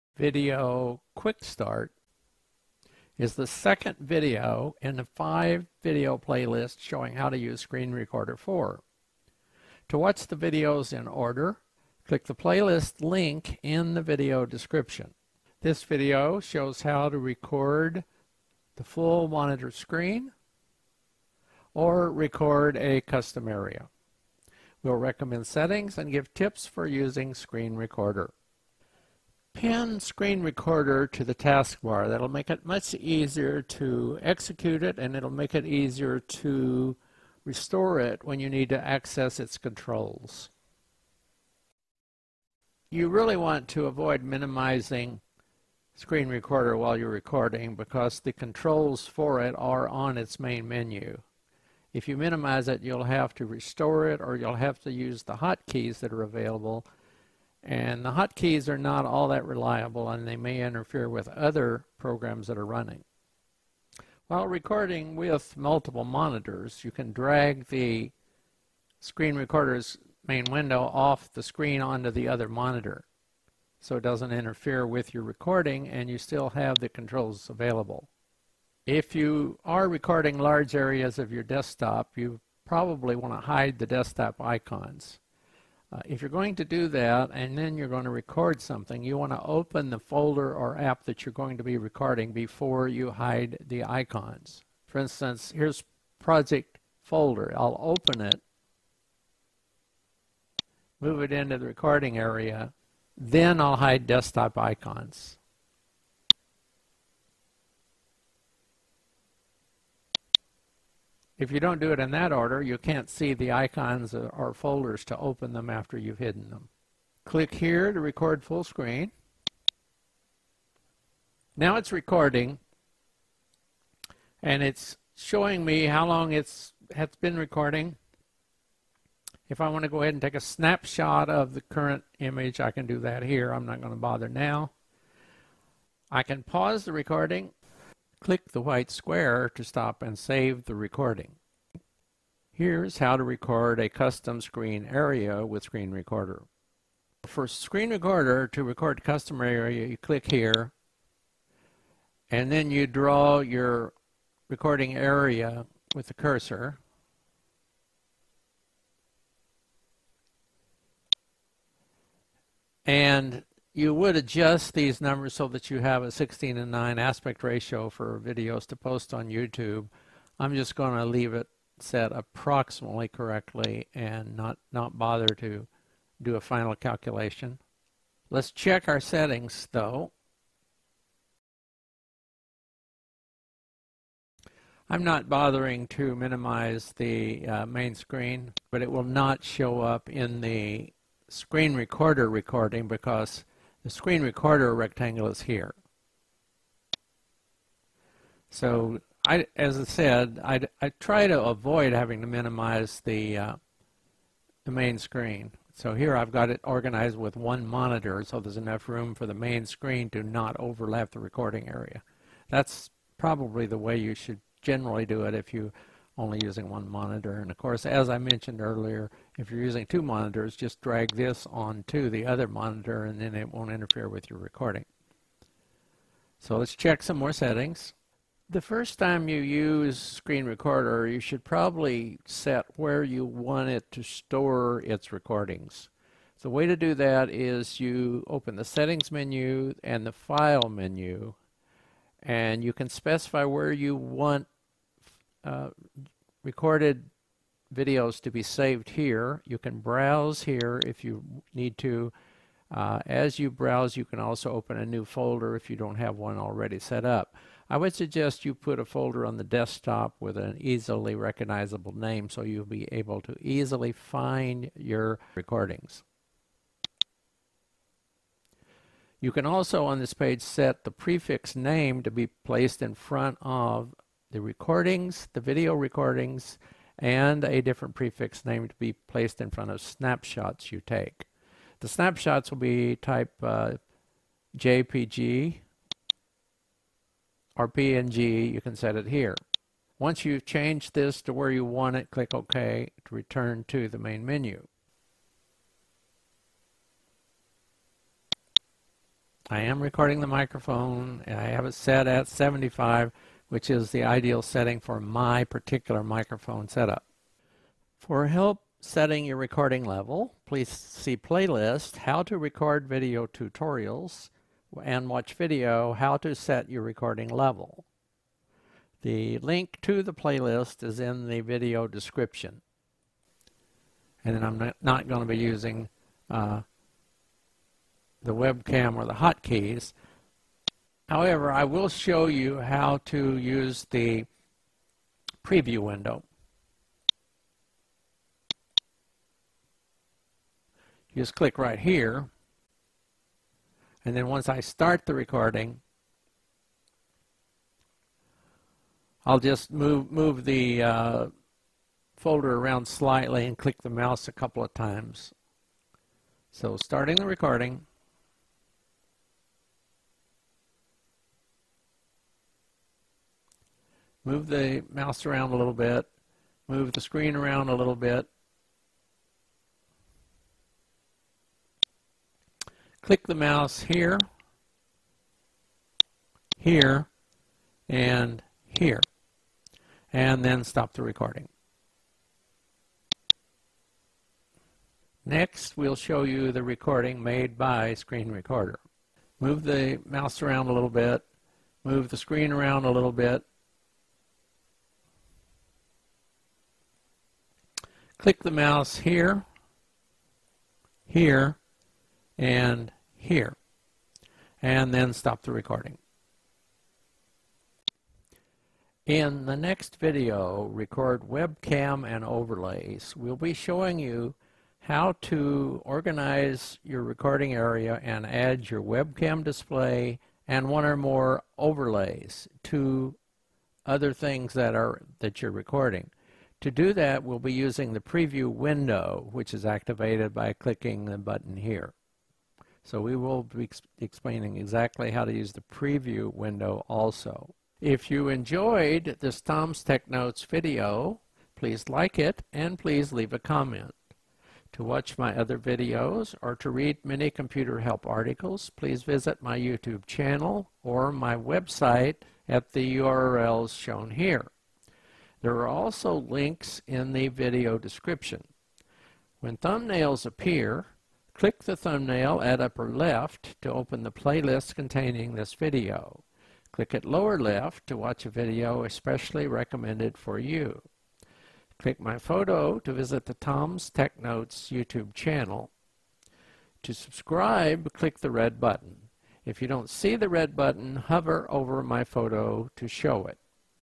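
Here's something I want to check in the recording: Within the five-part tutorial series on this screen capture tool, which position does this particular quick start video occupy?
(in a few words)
second.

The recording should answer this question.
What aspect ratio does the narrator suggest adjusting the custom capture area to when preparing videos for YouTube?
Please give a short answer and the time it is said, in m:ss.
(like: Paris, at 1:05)
16 and 9, at 2:46.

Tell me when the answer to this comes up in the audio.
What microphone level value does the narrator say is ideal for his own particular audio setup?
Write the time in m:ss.
5:02.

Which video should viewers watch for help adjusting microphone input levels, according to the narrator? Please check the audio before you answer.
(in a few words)
How to Set Your Recording Level.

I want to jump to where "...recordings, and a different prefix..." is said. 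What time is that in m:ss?
4:35.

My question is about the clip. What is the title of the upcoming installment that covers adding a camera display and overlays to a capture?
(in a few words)
Record Webcam and Overlays.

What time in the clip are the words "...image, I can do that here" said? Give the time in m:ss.
2:12.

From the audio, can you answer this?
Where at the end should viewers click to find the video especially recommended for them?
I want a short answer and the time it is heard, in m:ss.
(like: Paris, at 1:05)
lower left, at 7:47.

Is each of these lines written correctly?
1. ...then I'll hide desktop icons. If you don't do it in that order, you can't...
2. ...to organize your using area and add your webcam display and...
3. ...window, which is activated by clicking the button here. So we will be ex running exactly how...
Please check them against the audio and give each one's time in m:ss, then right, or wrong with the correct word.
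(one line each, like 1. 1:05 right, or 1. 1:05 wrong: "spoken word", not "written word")
1. 1:43 right
2. 6:55 wrong: "recording", not "using"
3. 7:08 wrong: "explaining", not "running".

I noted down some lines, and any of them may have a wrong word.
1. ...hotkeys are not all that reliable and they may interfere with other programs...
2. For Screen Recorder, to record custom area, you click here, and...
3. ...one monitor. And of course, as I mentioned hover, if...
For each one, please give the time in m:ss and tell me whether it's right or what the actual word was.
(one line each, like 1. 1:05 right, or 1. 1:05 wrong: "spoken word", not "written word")
1. 0:58 right
2. 2:27 right
3. 3:36 wrong: "earlier", not "hover".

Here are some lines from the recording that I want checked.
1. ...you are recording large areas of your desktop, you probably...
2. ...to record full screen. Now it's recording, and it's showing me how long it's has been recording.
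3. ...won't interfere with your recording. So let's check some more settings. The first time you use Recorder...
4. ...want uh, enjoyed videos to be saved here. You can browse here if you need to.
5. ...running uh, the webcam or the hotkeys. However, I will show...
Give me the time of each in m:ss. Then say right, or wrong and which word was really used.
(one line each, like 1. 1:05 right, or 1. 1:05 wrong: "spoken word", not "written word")
1. 1:19 right
2. 1:57 right
3. 3:43 wrong: "Screen", not "Recorder"
4. 4:03 wrong: "recorded", not "enjoyed"
5. 5:25 wrong: "using", not "running".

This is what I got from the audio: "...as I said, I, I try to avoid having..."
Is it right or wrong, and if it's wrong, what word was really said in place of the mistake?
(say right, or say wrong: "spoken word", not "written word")
right.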